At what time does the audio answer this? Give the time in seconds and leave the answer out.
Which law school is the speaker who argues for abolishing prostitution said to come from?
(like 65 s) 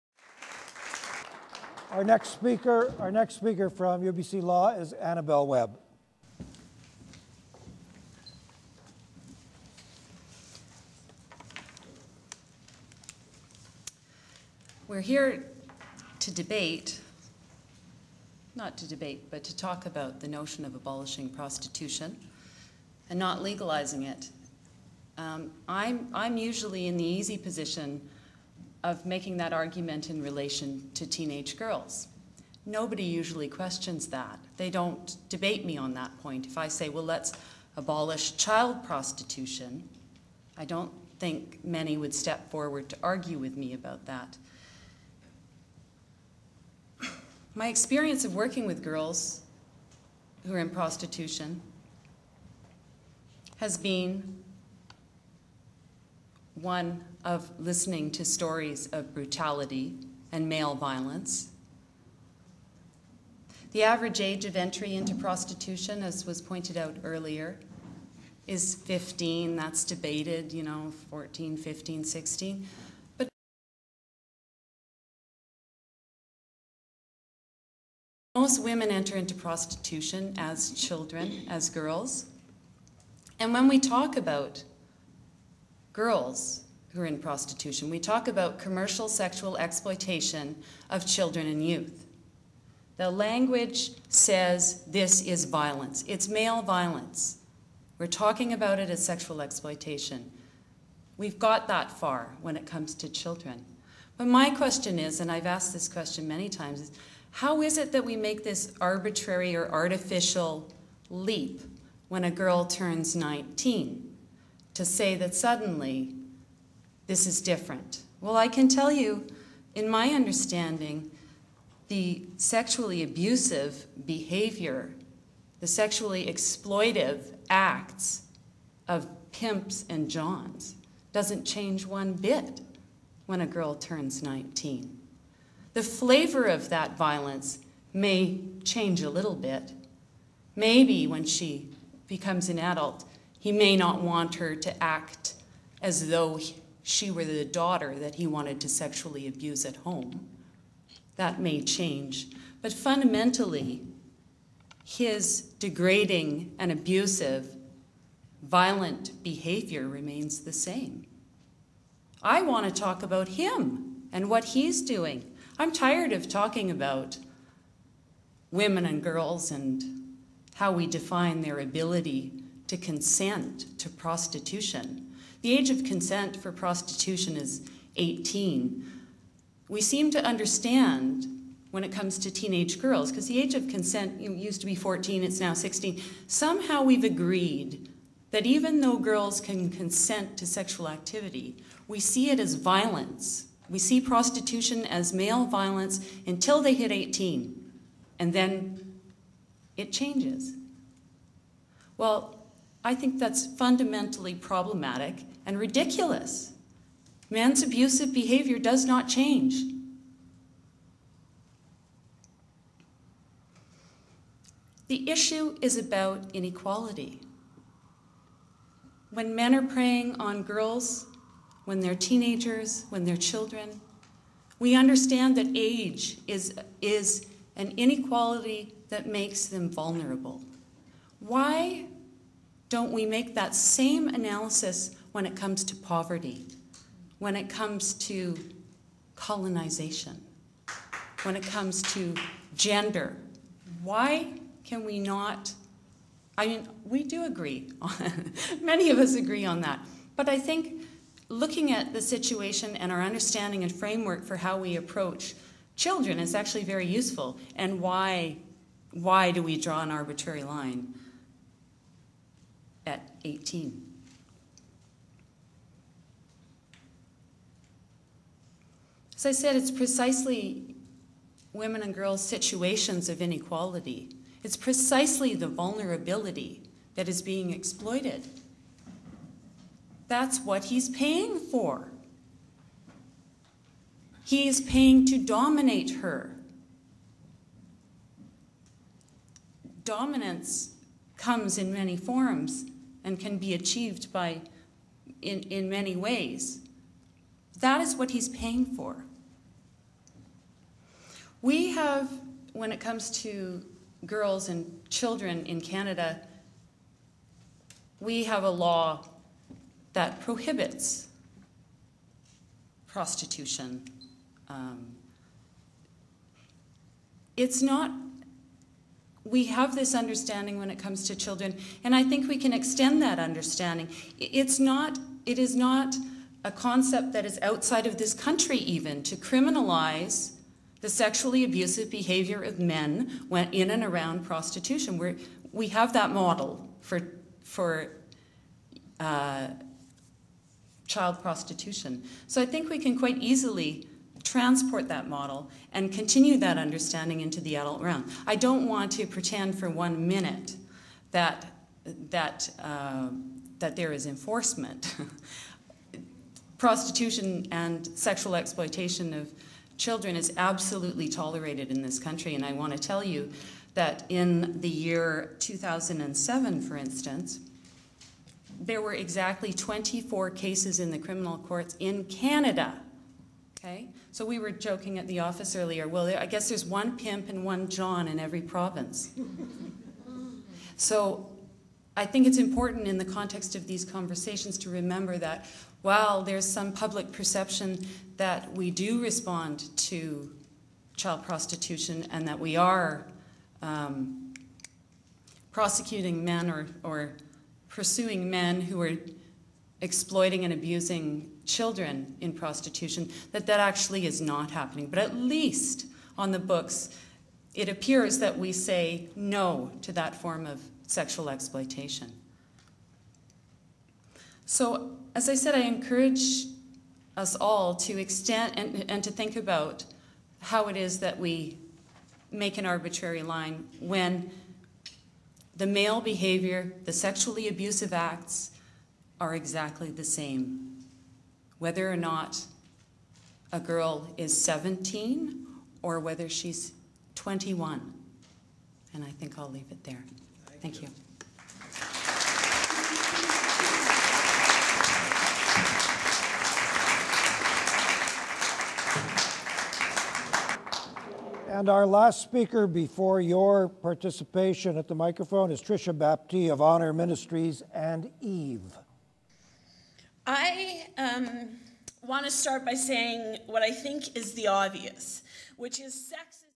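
4 s.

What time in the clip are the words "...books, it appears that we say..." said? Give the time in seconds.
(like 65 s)
406 s.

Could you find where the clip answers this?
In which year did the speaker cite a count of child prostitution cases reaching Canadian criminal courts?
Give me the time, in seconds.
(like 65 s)
365 s.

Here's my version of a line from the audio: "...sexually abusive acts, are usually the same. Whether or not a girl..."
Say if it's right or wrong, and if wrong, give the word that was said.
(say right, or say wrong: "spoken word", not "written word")
wrong: "exactly", not "usually".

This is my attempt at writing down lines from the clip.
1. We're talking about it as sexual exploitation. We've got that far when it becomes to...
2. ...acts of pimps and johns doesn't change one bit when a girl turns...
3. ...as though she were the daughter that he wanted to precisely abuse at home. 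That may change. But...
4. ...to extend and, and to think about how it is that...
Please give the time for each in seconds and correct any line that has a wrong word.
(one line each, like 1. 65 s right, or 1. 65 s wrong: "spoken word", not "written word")
1. 97 s wrong: "comes", not "becomes"
2. 127 s right
3. 145 s wrong: "sexually", not "precisely"
4. 417 s right.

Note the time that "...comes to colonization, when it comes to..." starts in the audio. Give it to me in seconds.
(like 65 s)
237 s.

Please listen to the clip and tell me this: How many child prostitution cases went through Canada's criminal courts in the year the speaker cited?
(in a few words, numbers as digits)
24.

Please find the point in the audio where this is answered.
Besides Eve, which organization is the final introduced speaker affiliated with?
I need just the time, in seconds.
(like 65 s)
456 s.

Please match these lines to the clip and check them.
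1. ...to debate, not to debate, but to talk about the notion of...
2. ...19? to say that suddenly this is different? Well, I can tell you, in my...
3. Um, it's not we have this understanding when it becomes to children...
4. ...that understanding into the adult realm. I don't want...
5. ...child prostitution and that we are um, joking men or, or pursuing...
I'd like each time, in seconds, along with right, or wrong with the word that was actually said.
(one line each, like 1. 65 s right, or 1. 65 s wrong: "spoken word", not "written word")
1. 16 s right
2. 113 s right
3. 314 s wrong: "comes", not "becomes"
4. 346 s right
5. 390 s wrong: "prosecuting", not "joking".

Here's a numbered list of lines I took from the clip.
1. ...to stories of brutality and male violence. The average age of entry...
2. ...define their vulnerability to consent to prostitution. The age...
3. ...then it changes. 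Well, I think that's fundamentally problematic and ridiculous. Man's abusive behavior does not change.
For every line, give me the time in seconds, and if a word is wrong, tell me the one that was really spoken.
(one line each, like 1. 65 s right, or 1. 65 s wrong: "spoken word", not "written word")
1. 58 s right
2. 170 s wrong: "ability", not "vulnerability"
3. 198 s right.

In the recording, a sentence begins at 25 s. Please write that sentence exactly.
Um, I'm, I'm usually in the easy position of making that argument in relation to teenage girls.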